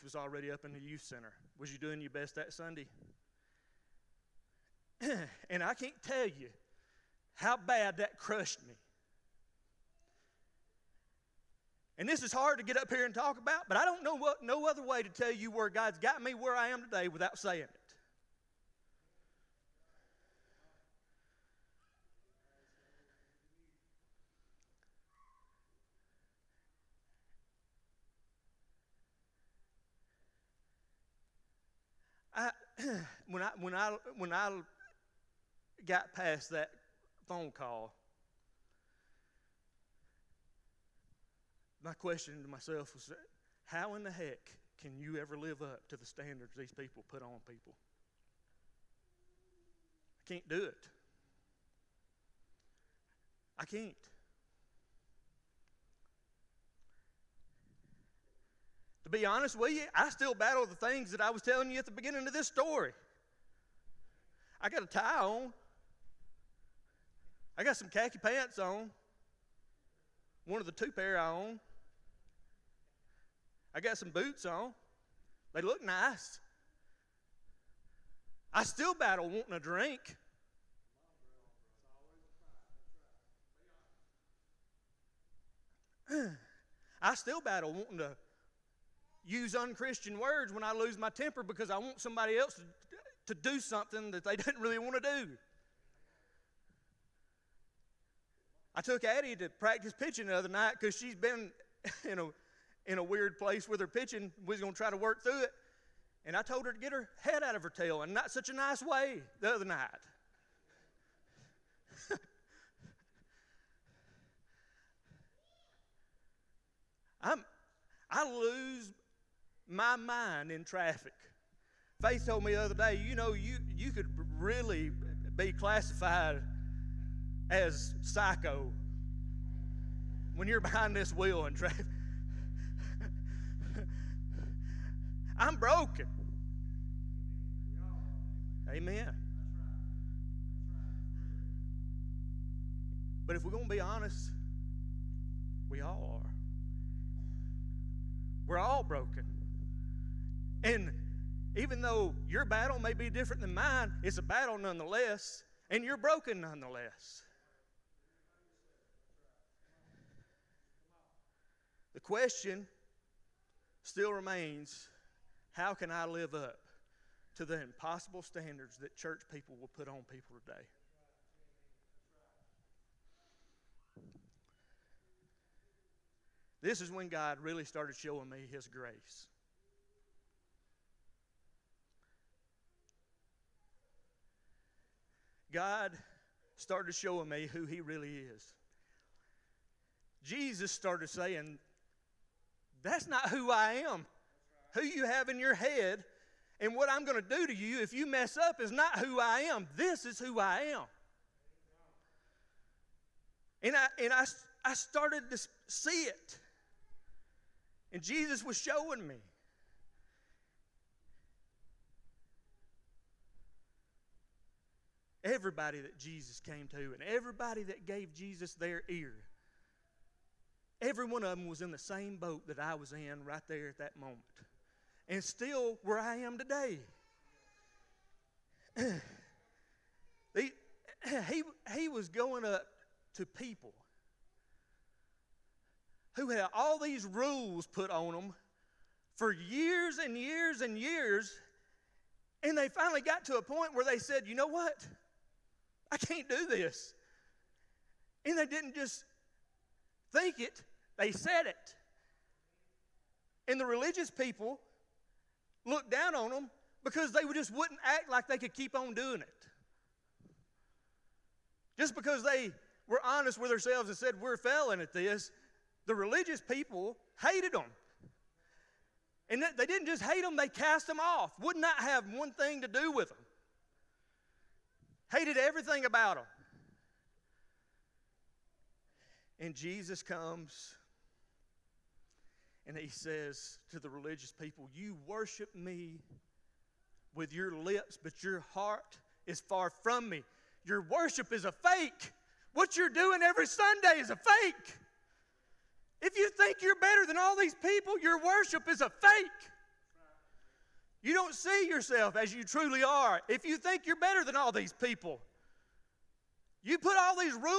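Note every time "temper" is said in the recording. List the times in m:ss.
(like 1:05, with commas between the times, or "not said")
1:31.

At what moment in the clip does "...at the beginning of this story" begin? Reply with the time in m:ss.
1:01.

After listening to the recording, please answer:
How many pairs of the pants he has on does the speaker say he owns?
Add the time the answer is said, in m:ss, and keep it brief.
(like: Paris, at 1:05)
2, at 1:10.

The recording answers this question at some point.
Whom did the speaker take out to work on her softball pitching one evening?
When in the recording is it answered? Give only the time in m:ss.
1:39.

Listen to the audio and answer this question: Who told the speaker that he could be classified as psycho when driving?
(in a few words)
Faith.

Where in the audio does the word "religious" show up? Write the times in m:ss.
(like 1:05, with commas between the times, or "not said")
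4:13, 4:25, 4:43.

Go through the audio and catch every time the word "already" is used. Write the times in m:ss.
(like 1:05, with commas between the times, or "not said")
0:00.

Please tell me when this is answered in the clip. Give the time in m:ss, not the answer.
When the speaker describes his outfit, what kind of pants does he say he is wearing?
1:07.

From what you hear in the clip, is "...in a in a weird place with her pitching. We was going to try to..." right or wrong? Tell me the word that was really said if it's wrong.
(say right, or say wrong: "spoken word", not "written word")
right.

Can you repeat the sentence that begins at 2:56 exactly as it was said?
This is when God really started showing me His grace.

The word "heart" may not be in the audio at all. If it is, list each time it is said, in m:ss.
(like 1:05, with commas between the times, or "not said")
4:48.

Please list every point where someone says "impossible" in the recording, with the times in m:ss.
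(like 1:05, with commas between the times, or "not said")
2:47.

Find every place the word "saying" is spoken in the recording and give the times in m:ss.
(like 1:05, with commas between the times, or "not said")
0:17, 3:11.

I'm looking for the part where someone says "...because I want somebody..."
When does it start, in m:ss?
1:31.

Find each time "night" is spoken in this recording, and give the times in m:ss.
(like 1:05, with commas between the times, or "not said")
1:40, 1:49.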